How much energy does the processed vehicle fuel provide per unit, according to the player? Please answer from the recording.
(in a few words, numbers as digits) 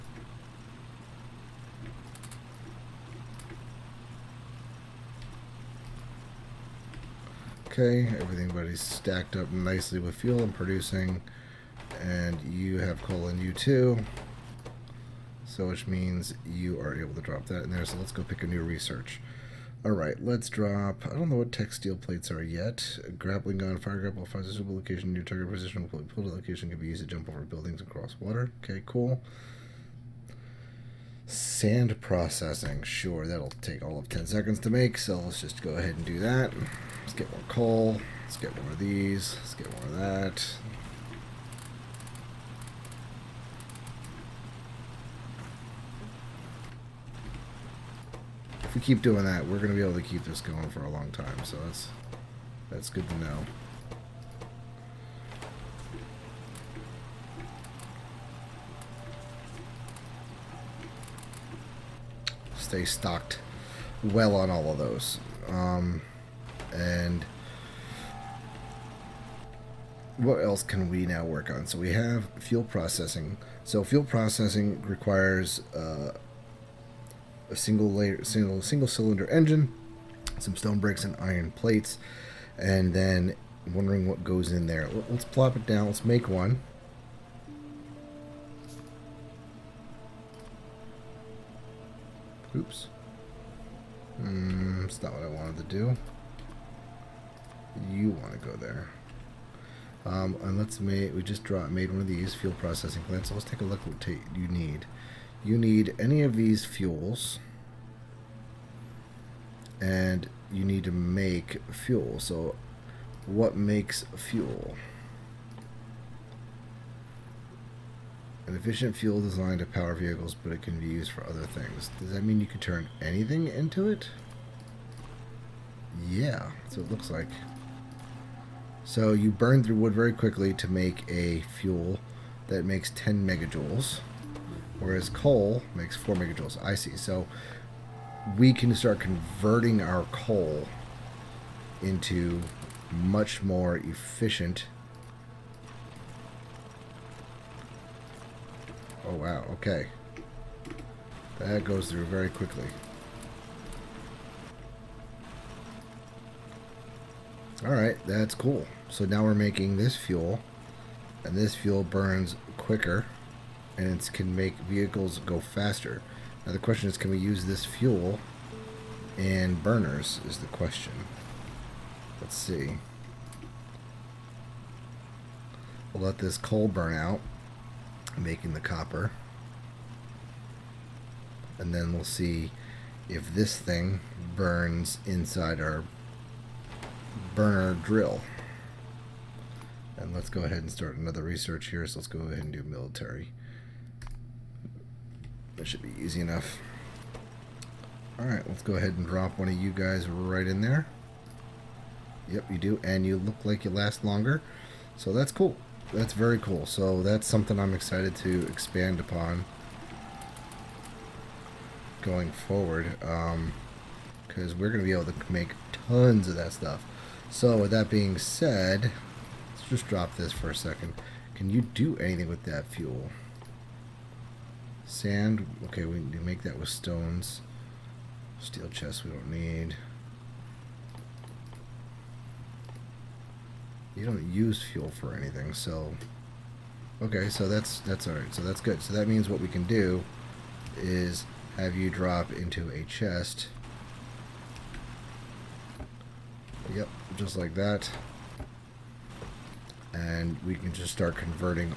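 10 megajoules.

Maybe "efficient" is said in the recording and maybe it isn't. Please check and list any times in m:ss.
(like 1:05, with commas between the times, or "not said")
1:58, 2:23.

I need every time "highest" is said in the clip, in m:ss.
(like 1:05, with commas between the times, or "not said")
not said.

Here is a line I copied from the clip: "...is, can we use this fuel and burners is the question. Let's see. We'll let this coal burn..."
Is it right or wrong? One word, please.
right.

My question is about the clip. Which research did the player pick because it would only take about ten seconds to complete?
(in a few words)
Sand processing.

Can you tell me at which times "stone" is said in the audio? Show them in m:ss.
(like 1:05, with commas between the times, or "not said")
1:20, 3:46.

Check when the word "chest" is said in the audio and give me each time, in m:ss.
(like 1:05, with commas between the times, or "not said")
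3:48, 4:02.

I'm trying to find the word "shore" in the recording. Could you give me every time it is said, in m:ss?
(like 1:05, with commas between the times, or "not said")
not said.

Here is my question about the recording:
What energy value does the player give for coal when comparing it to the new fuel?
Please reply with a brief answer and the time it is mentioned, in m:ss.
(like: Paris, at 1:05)
4 megajoules, at 2:15.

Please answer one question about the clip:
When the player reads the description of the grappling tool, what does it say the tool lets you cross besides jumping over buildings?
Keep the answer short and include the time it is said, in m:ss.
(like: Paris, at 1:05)
water, at 0:27.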